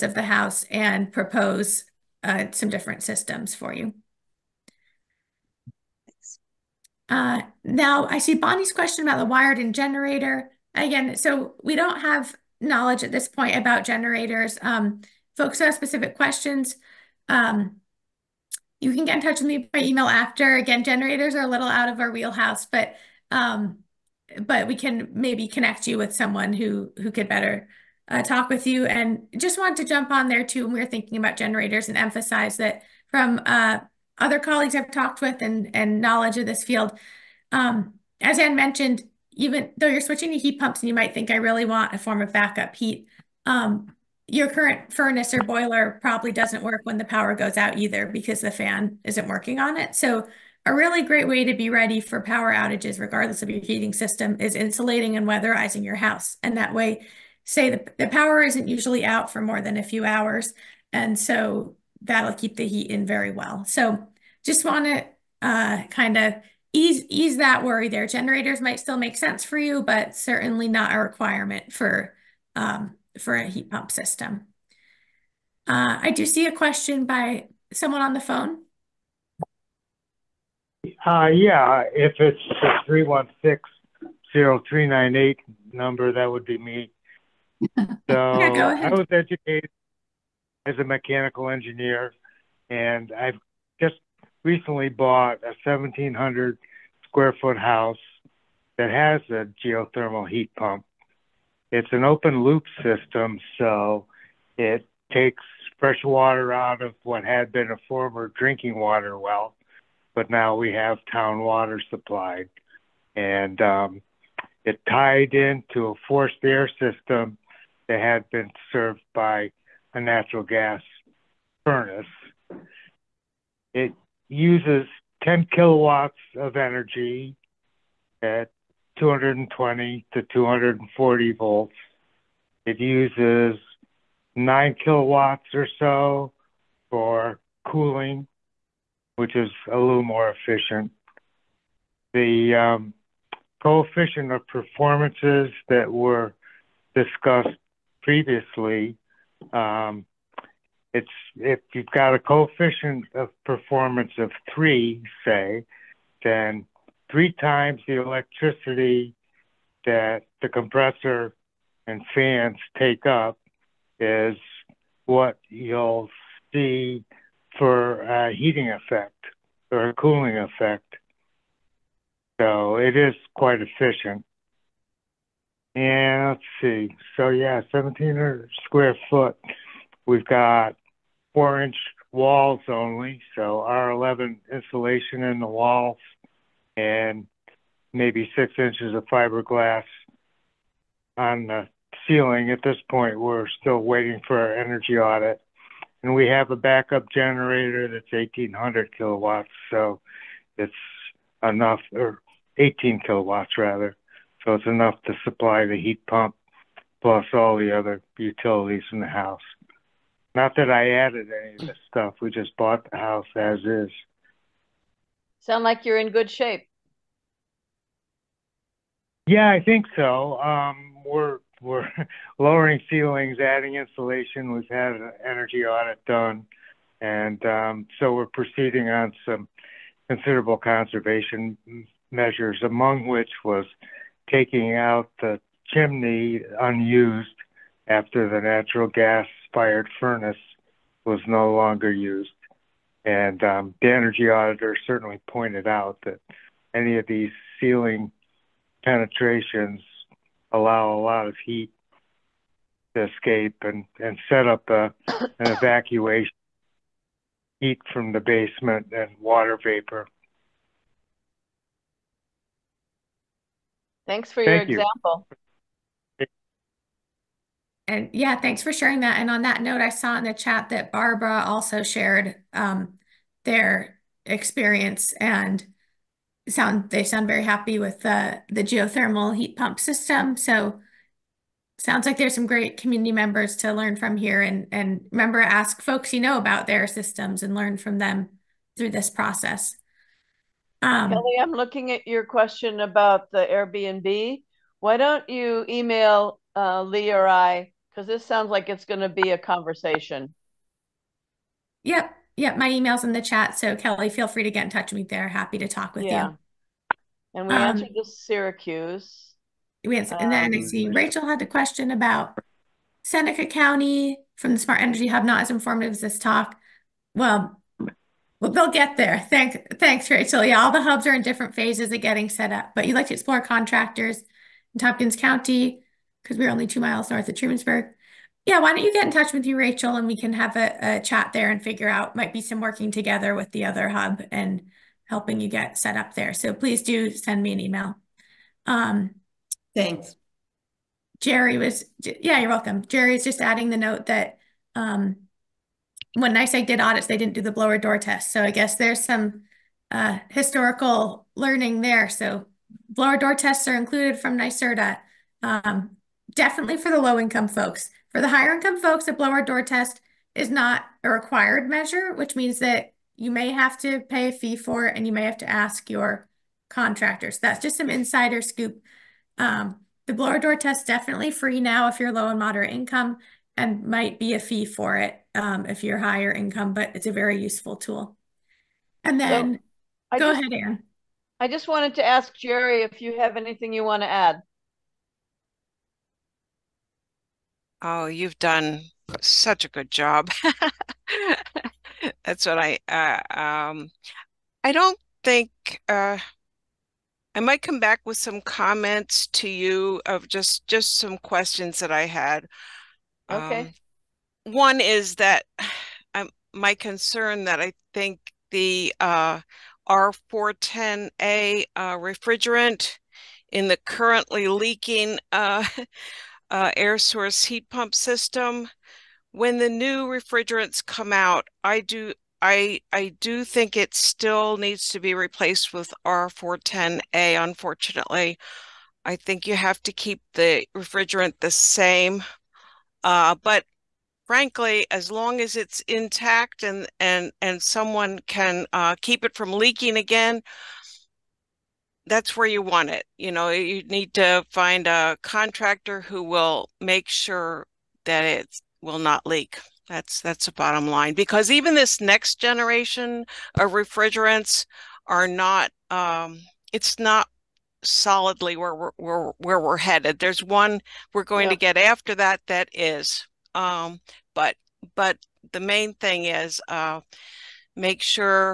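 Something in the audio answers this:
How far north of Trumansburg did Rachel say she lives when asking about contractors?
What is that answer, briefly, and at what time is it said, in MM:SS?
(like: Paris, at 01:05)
2 miles, at 05:26.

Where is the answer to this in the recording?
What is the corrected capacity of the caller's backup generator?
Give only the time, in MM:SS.
03:22.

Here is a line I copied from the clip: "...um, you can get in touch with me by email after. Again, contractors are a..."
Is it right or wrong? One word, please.
wrong.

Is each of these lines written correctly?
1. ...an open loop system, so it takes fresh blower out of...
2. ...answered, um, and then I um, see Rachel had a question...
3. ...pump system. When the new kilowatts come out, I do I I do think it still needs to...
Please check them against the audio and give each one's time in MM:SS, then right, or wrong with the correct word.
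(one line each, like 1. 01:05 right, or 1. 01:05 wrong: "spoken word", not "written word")
1. 01:41 wrong: "water", not "blower"
2. 05:09 right
3. 06:57 wrong: "refrigerants", not "kilowatts".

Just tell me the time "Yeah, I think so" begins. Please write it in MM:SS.
03:39.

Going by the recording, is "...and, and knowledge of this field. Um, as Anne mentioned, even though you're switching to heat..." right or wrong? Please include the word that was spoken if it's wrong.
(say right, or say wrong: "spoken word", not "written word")
right.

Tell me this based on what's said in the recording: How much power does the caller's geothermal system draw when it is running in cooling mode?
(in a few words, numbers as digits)
9 kilowatts.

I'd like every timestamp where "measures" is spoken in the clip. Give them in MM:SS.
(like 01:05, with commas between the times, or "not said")
03:52, 06:01.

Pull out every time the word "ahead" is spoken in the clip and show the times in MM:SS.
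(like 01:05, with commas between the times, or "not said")
06:20.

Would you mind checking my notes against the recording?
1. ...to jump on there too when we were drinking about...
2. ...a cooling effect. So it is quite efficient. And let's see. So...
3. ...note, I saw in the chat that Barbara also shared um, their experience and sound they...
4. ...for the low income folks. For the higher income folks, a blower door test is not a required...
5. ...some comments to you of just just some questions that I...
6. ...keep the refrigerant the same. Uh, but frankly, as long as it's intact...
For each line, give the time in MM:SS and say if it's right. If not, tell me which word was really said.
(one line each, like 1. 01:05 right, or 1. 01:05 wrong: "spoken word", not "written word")
1. 00:29 wrong: "thinking", not "drinking"
2. 02:49 right
3. 04:29 right
4. 05:56 right
5. 06:38 right
6. 07:09 right.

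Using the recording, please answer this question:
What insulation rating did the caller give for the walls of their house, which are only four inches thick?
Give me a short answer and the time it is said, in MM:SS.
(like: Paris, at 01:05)
R11, at 03:03.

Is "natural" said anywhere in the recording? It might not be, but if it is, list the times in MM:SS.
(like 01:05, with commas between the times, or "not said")
01:59, 03:58.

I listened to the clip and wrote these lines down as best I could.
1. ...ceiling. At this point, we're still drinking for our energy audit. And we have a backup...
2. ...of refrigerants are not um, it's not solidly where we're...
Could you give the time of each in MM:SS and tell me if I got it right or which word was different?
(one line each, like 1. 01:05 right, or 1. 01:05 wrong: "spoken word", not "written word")
1. 03:12 wrong: "waiting", not "drinking"
2. 07:33 right.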